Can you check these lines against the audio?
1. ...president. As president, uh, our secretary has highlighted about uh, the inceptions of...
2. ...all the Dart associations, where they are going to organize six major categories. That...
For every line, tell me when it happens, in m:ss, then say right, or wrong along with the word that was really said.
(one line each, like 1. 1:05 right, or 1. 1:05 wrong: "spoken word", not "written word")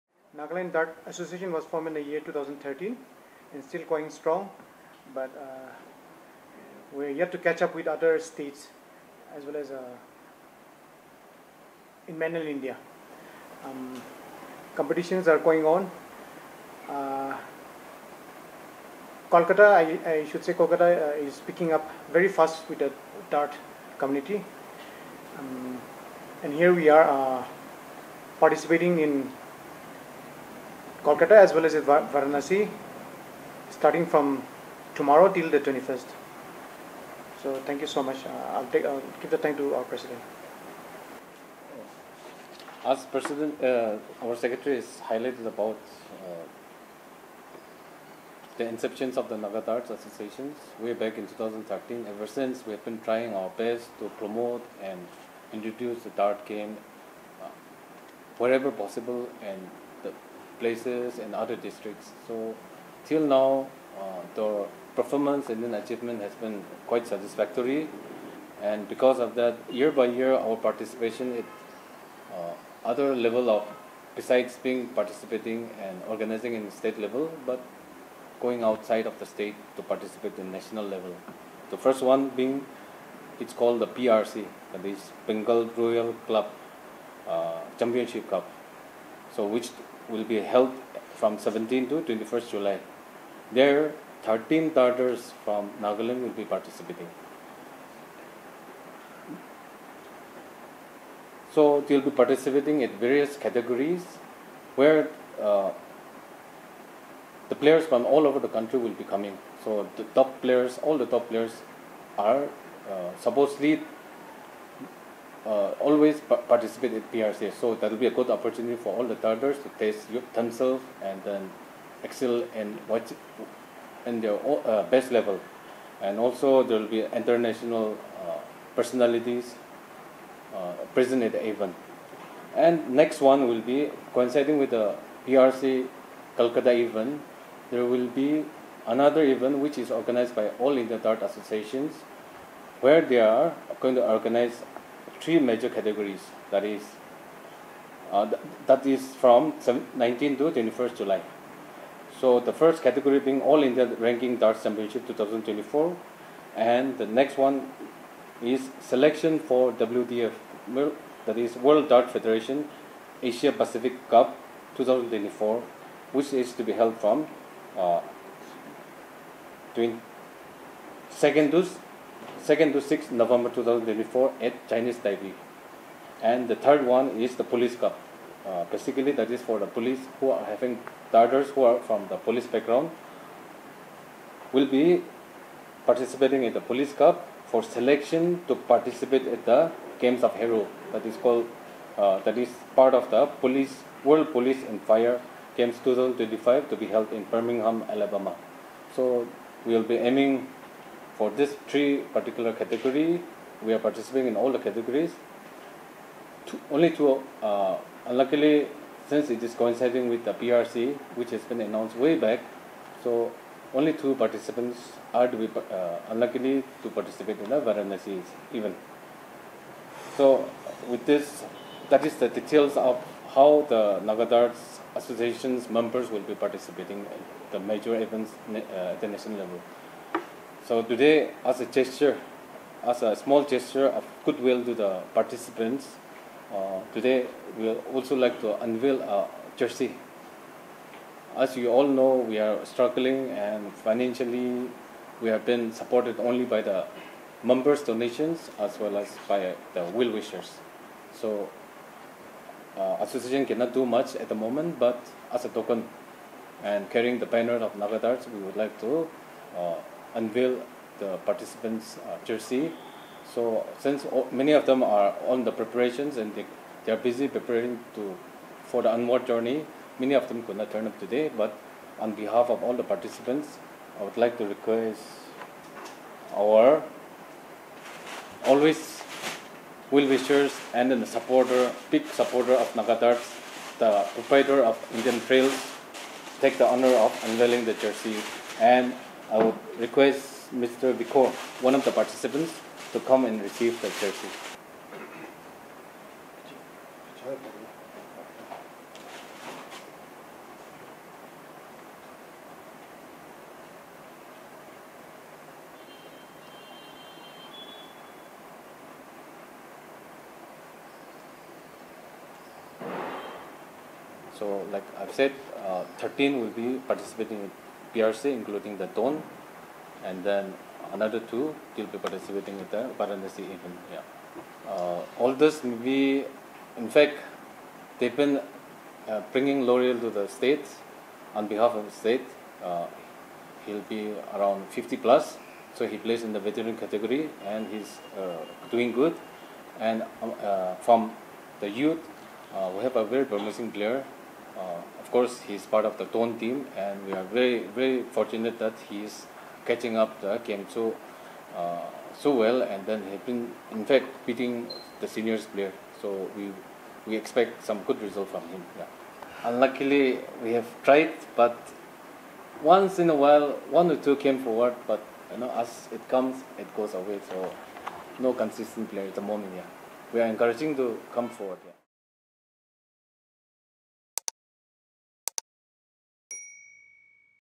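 1. 0:39 right
2. 2:20 wrong: "three", not "six".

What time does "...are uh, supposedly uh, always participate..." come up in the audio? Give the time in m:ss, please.
1:52.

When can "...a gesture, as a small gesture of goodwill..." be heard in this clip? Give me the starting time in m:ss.
3:51.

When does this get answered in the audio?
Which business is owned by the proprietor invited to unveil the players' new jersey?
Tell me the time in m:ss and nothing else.
4:44.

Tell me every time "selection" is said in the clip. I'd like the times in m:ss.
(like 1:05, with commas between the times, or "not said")
2:38, 3:07.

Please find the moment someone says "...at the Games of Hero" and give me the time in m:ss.
3:09.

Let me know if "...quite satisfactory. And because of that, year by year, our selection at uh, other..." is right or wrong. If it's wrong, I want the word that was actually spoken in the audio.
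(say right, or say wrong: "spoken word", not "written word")
wrong: "participation", not "selection".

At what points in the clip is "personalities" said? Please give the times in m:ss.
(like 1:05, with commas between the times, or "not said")
2:08.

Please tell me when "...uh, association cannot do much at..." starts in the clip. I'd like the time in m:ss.
4:12.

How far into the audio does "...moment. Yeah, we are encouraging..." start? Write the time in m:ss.
6:09.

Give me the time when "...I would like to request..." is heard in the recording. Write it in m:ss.
4:33.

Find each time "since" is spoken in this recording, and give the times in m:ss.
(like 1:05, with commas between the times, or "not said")
0:52, 3:29, 4:23.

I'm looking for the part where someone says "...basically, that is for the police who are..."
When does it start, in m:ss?
2:58.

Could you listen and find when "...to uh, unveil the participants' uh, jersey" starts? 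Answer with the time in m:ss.
4:18.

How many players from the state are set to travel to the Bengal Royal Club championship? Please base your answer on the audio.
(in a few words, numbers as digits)
13.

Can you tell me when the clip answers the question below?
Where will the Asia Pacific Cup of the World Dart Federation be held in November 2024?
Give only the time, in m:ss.
2:54.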